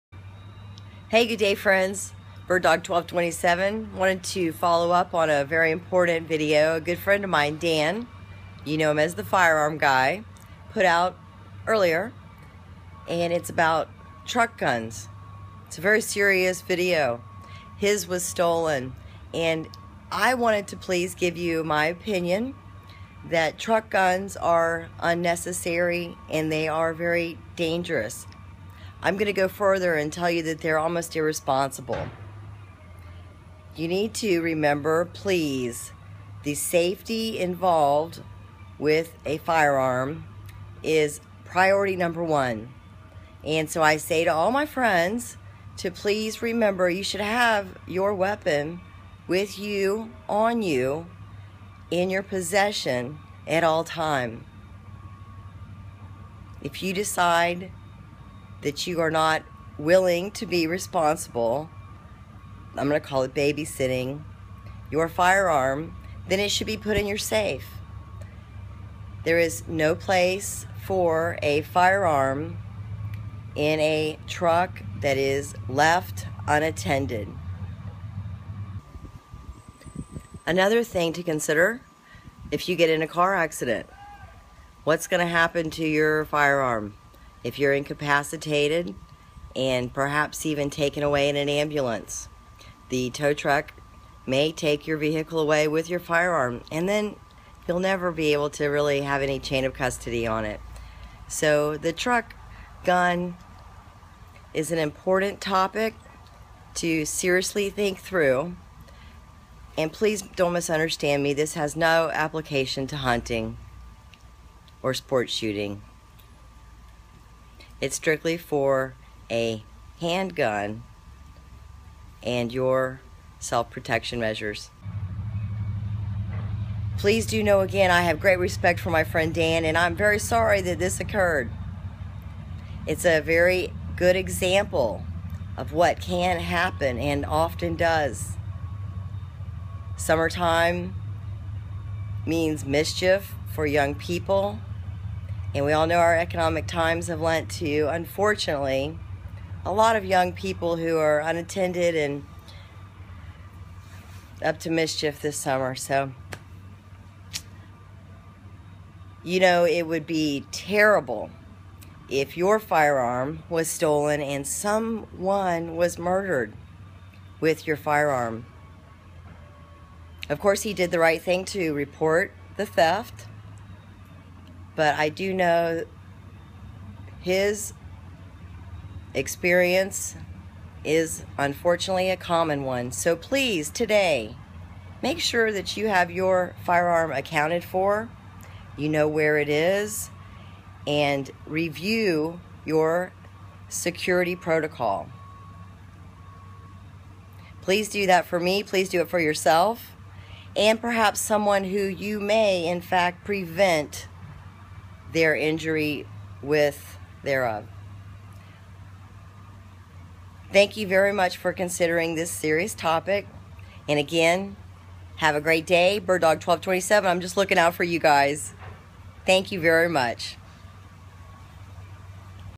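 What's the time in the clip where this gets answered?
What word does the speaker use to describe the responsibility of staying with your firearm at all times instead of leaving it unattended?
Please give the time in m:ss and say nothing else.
1:03.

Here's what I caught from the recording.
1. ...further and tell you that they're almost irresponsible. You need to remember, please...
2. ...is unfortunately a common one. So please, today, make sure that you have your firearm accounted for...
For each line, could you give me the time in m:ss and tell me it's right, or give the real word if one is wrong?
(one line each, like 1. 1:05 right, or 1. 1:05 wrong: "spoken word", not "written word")
1. 0:29 right
2. 3:00 right.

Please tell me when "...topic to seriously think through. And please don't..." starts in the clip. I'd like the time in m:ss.
1:45.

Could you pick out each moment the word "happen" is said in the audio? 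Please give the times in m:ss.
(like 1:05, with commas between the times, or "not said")
1:25, 2:16.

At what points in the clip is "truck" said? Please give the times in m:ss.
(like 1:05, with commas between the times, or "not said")
0:14, 0:23, 1:14, 1:33, 1:41.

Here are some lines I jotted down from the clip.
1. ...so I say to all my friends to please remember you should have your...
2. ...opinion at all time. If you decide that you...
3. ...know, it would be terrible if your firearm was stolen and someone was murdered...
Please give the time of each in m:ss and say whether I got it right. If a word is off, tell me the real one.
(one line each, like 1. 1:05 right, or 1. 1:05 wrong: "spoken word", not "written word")
1. 0:43 right
2. 0:52 wrong: "possession", not "opinion"
3. 2:39 right.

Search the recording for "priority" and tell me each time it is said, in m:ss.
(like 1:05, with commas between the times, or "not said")
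0:41.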